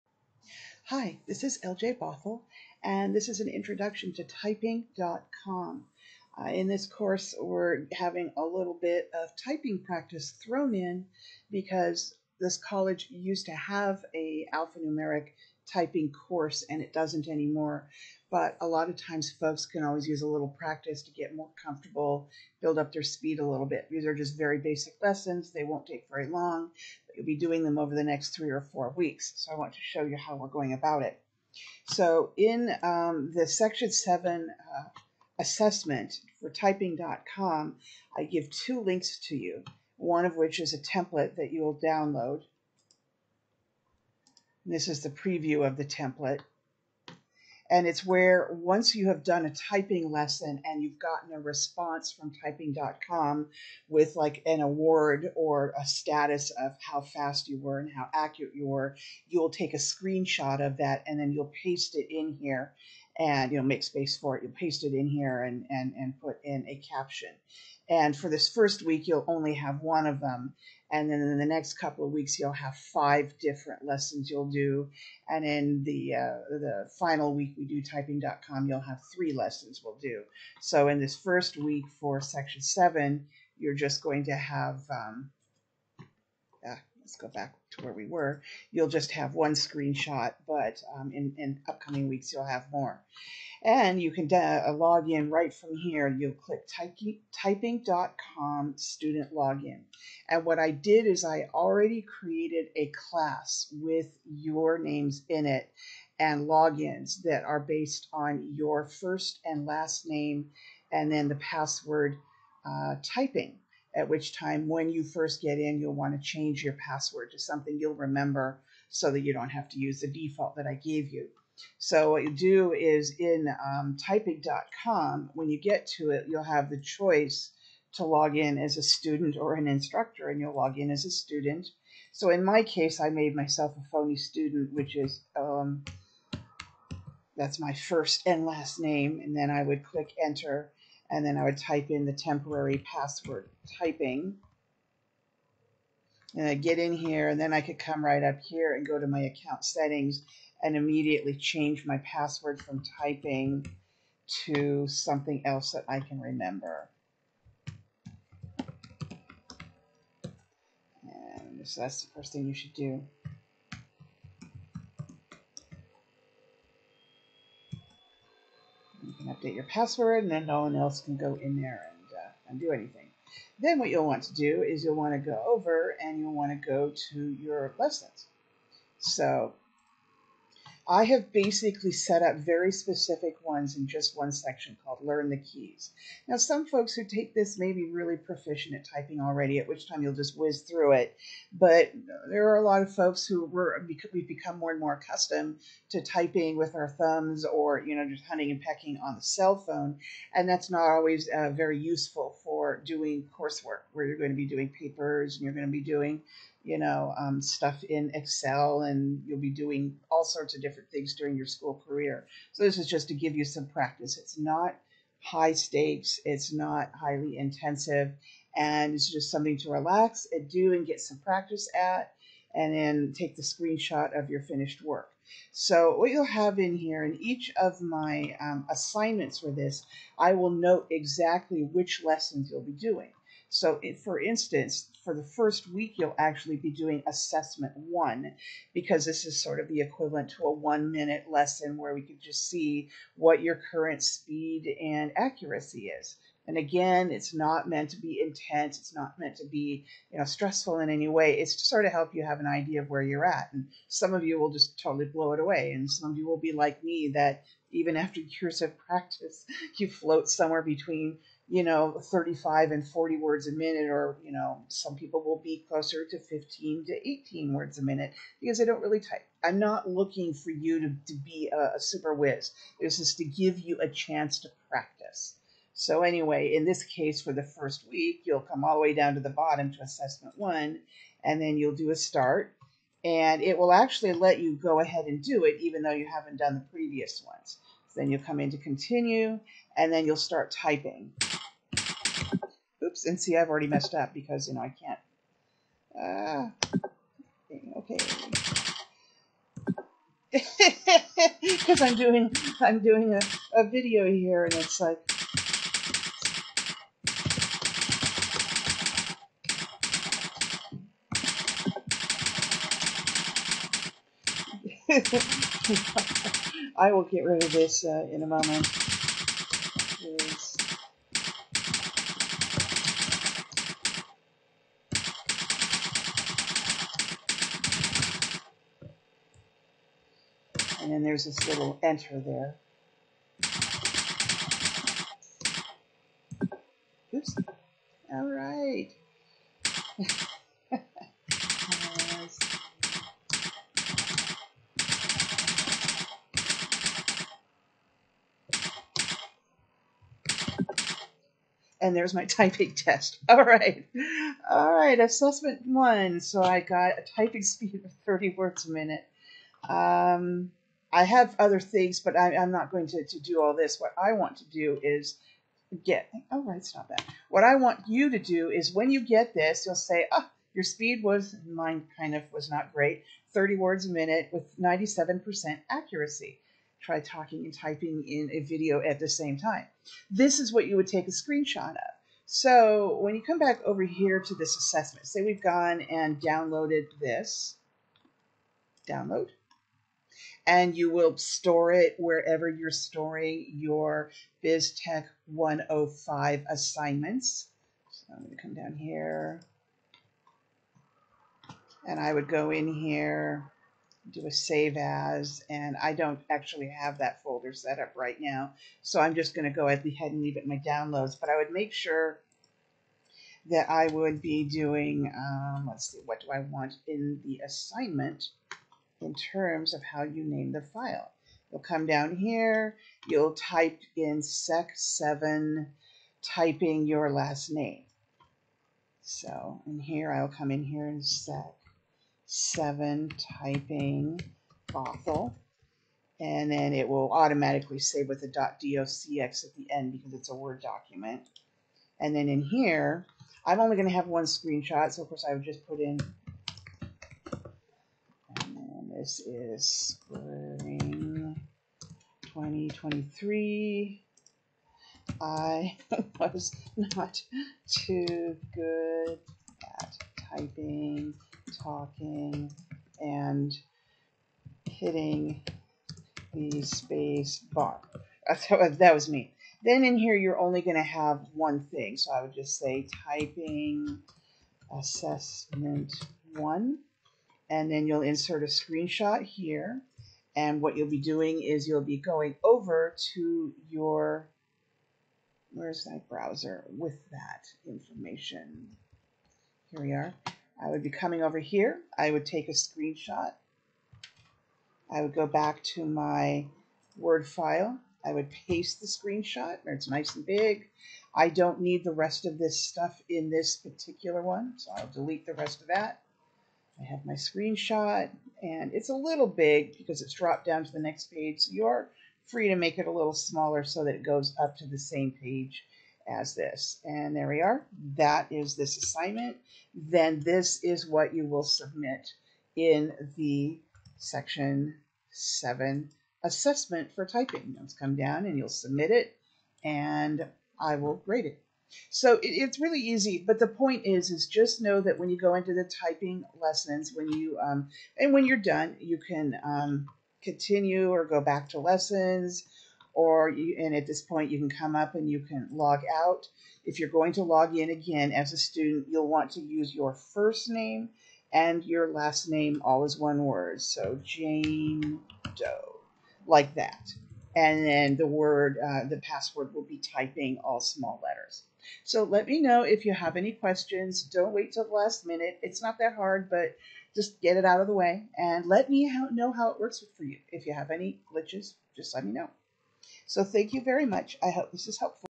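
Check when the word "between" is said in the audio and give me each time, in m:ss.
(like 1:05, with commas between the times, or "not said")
4:20.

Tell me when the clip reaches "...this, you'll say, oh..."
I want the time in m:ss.
6:09.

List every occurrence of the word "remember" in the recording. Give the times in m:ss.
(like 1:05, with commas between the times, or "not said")
1:57, 2:36.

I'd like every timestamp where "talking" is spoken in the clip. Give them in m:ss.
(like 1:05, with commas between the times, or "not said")
6:16, 7:41.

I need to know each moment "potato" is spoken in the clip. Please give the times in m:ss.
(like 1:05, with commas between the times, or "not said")
not said.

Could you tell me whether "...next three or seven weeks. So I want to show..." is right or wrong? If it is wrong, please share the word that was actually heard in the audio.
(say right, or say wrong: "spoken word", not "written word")
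wrong: "four", not "seven".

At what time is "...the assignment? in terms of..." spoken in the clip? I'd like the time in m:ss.
6:57.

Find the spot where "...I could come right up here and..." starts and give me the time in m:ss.
2:27.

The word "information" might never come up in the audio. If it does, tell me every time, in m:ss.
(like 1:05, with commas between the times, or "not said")
8:07.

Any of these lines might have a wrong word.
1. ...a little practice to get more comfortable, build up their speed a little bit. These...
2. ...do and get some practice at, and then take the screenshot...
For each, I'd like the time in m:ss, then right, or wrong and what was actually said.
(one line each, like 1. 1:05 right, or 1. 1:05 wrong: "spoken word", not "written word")
1. 0:20 right
2. 3:40 right.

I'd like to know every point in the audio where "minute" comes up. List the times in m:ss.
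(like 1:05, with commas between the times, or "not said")
4:00, 4:23, 4:27, 5:58, 6:13, 9:25.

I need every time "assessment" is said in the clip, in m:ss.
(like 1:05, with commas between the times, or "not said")
0:35, 3:57, 4:39, 5:54, 6:24, 7:54, 8:46.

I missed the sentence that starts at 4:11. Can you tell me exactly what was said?
It's to sort of help you have an idea of where you're at.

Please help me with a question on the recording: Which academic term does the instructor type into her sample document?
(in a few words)
spring 2023.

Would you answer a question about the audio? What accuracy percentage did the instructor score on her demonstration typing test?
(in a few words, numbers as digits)
97%.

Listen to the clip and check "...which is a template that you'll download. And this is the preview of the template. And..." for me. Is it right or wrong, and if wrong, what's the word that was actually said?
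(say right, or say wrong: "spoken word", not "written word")
right.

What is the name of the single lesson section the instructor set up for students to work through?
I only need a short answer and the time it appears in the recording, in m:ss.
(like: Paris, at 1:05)
Learn the Keys, at 3:05.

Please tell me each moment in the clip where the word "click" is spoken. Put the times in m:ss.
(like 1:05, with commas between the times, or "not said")
1:36, 2:19.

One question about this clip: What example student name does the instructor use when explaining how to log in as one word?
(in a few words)
Jane Doe.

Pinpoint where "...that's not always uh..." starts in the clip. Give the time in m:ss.
3:20.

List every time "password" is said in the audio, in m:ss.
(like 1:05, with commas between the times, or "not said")
1:51, 1:56, 2:22, 2:32, 2:49, 9:18.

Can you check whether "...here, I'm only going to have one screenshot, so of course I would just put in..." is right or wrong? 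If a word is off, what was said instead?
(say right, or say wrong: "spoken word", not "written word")
right.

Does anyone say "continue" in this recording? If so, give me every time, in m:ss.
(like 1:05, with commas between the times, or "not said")
4:48, 9:00.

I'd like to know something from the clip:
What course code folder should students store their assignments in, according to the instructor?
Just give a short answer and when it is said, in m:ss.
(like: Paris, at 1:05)
BizTech 105, at 6:34.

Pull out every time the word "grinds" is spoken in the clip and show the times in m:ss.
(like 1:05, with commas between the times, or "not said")
not said.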